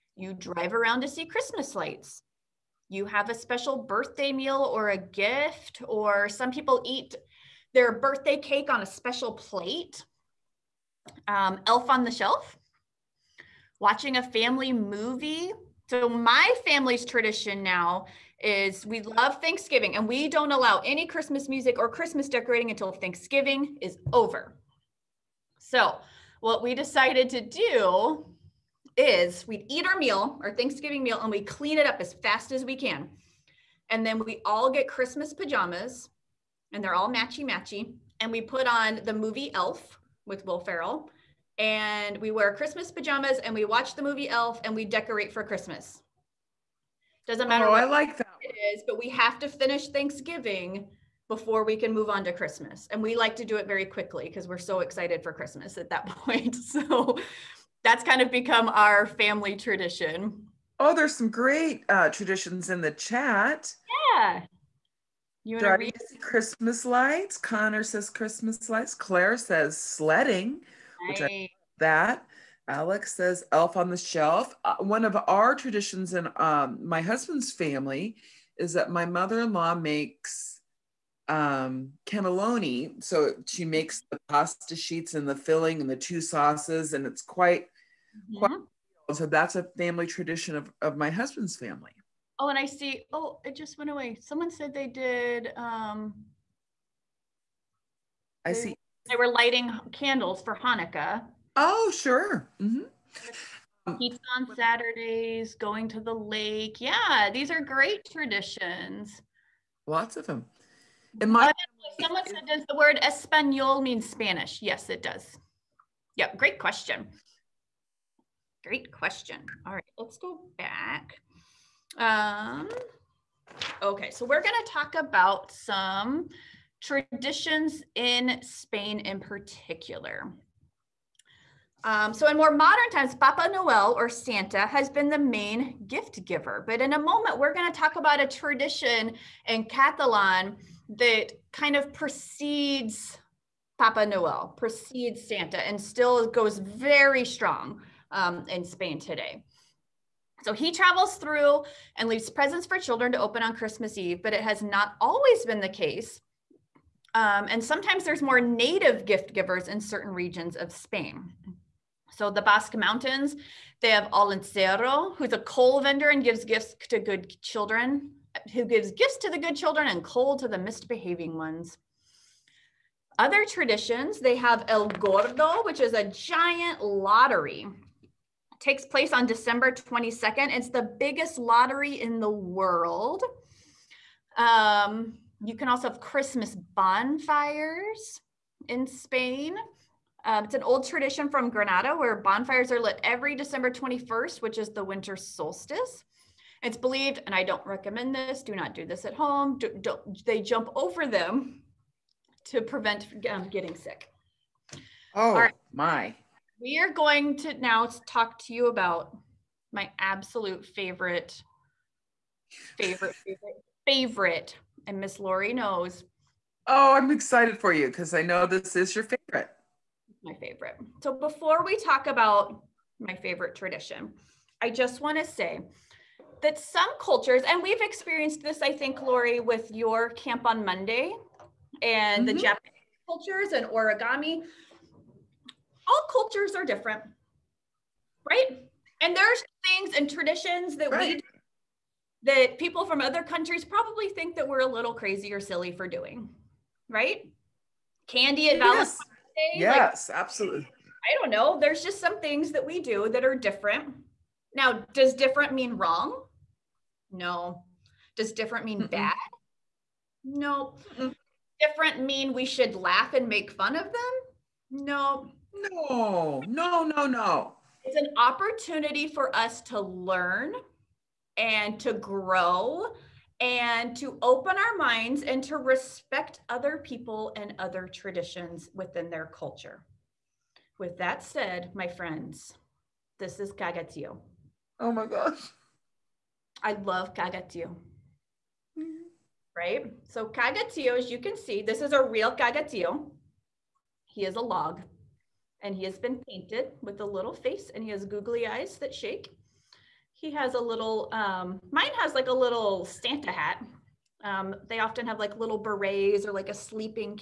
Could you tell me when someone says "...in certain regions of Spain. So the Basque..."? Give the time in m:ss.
2:39.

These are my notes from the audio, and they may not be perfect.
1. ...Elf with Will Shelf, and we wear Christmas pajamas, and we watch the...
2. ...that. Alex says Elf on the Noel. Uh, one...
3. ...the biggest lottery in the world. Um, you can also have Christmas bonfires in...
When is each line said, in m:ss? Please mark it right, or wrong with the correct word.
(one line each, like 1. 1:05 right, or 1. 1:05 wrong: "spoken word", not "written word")
1. 0:39 wrong: "Ferrell", not "Shelf"
2. 1:11 wrong: "Shelf", not "Noel"
3. 3:00 right.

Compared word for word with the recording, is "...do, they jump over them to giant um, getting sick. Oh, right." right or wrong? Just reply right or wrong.
wrong.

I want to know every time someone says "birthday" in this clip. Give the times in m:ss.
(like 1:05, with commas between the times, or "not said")
0:03, 0:07.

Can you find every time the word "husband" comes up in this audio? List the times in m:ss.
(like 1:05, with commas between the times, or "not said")
1:17, 1:31.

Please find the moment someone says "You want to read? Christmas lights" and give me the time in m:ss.
1:05.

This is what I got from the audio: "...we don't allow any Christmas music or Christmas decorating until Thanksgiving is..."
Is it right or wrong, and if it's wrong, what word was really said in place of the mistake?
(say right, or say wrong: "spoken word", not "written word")
right.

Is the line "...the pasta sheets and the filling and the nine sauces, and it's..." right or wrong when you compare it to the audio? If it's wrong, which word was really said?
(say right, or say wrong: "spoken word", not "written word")
wrong: "two", not "nine".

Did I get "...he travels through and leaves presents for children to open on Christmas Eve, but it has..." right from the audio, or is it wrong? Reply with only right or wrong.
right.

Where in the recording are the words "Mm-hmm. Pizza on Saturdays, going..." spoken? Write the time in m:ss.
1:42.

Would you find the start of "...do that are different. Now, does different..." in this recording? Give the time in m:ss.
4:12.